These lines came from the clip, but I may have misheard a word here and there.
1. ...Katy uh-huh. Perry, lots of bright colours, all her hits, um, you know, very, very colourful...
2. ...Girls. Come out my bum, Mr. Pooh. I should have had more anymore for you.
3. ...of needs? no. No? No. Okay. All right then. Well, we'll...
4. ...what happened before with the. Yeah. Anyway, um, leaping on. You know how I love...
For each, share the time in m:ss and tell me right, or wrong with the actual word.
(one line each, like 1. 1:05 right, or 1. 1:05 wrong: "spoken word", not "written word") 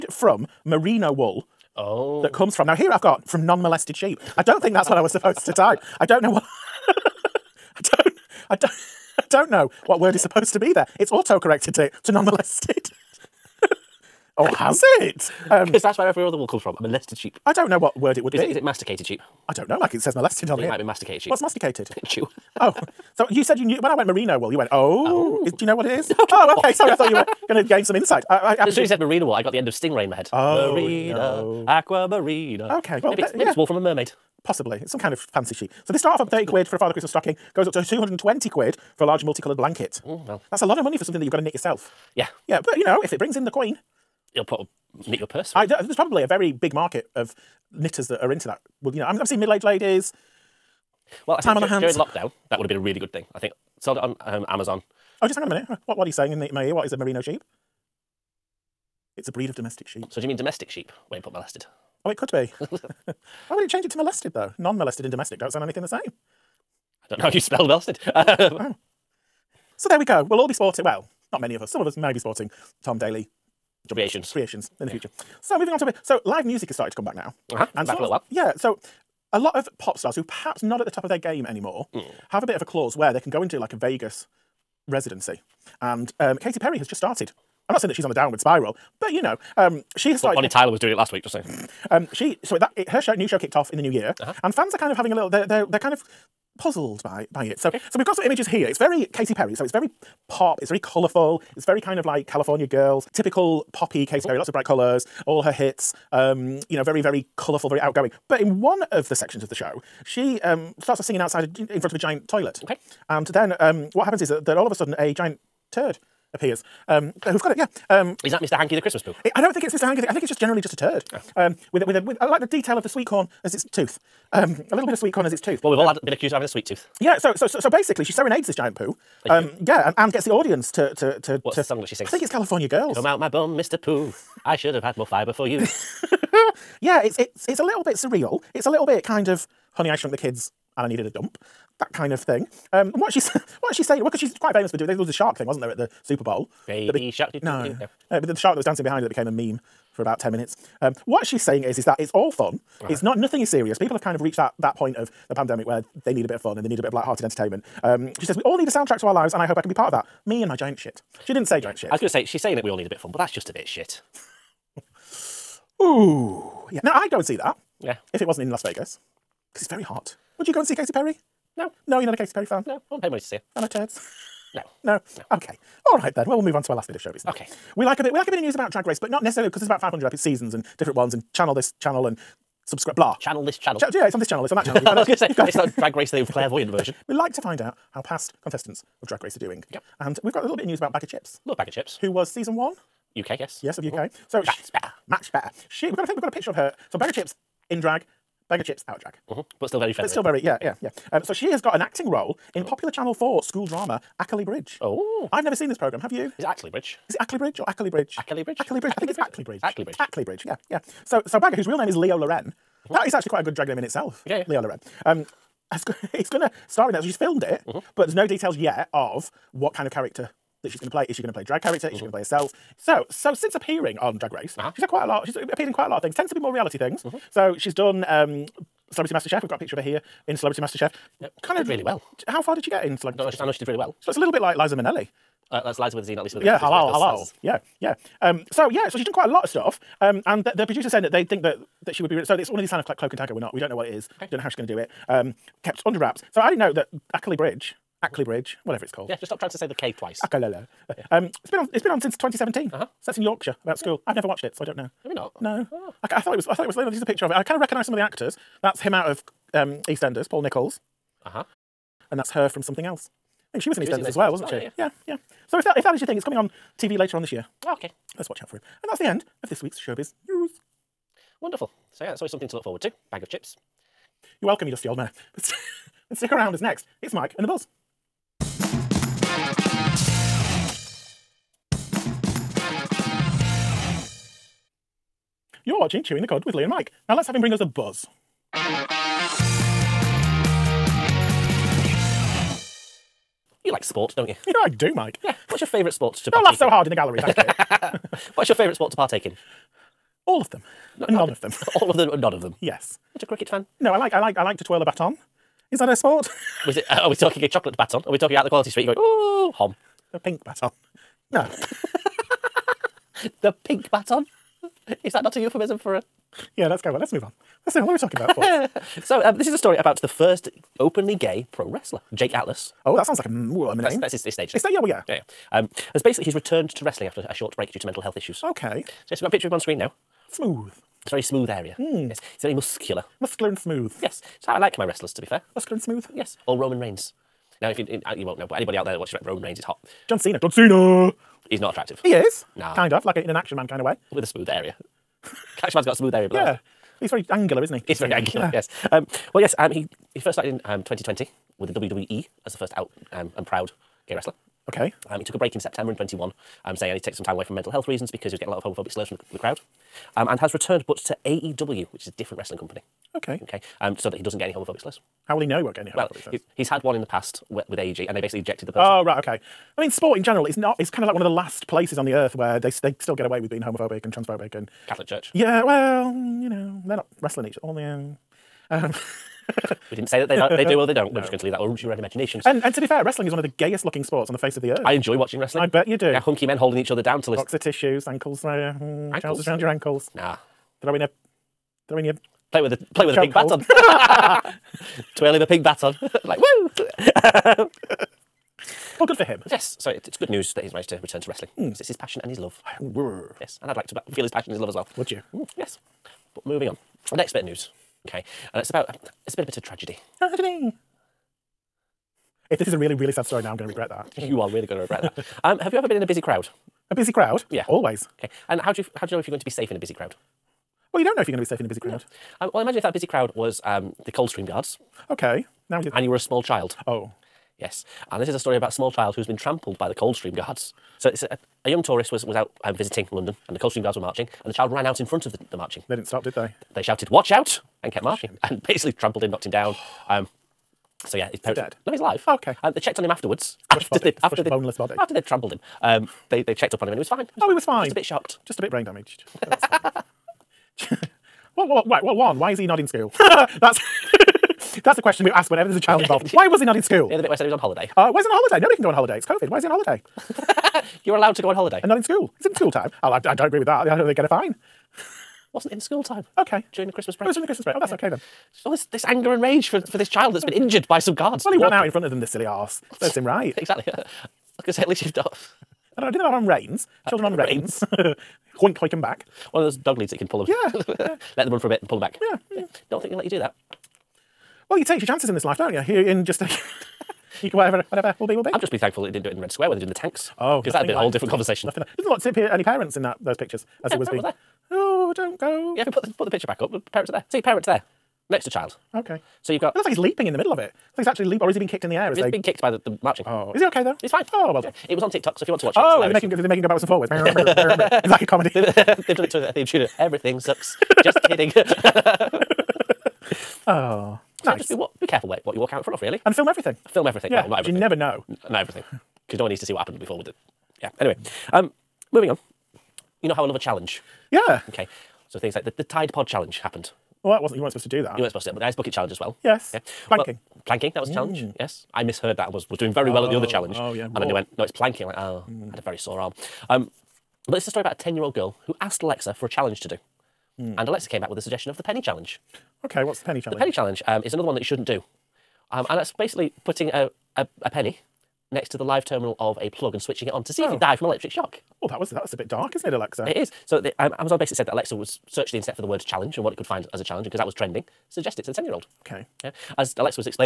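1. 1:44 right
2. 2:12 wrong: "fibre", not "anymore"
3. 2:53 wrong: "turds", not "needs"
4. 8:39 wrong: "moving", not "leaping".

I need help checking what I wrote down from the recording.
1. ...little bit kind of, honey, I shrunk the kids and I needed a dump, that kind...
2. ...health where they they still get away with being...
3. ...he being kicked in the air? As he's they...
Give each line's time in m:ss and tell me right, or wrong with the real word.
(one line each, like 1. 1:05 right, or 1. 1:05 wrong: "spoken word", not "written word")
1. 2:18 right
2. 6:12 wrong: "earth", not "health"
3. 8:21 right.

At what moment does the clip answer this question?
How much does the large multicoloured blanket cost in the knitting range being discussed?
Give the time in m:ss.
0:37.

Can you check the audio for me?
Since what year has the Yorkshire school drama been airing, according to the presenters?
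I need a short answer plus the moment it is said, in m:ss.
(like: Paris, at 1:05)
2017, at 4:12.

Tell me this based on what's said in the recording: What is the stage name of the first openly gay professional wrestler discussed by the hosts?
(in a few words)
Jake Atlas.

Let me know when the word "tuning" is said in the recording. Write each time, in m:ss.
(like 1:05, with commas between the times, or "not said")
not said.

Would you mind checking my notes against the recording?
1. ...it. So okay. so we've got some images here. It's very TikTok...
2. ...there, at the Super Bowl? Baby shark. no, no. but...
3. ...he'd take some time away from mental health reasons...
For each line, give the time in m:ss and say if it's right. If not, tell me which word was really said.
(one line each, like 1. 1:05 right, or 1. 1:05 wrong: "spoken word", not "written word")
1. 1:37 wrong: "Katy", not "TikTok"
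2. 2:25 right
3. 5:56 right.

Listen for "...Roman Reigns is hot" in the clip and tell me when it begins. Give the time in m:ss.
5:39.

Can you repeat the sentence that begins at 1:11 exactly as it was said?
Some of us may be sporting Tom Daley jump, creations creations in the yeah.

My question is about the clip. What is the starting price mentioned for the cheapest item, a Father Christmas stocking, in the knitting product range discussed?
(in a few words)
30 quid.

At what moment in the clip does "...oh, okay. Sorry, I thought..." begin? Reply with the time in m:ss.
0:26.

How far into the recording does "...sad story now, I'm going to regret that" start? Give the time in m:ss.
6:53.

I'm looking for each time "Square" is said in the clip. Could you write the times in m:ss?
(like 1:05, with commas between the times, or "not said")
8:09.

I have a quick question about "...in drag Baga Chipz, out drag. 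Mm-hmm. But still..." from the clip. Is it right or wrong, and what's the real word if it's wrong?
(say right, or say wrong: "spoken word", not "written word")
right.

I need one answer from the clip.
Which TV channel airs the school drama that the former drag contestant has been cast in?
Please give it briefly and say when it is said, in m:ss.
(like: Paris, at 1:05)
Channel 4, at 3:22.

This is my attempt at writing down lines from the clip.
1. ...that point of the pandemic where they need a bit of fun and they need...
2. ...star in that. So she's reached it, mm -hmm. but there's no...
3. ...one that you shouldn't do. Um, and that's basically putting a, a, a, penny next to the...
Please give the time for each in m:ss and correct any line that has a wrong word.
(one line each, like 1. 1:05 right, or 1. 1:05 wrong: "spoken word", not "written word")
1. 2:34 right
2. 3:36 wrong: "filmed", not "reached"
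3. 9:04 right.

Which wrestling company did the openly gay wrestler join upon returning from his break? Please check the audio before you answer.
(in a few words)
AEW.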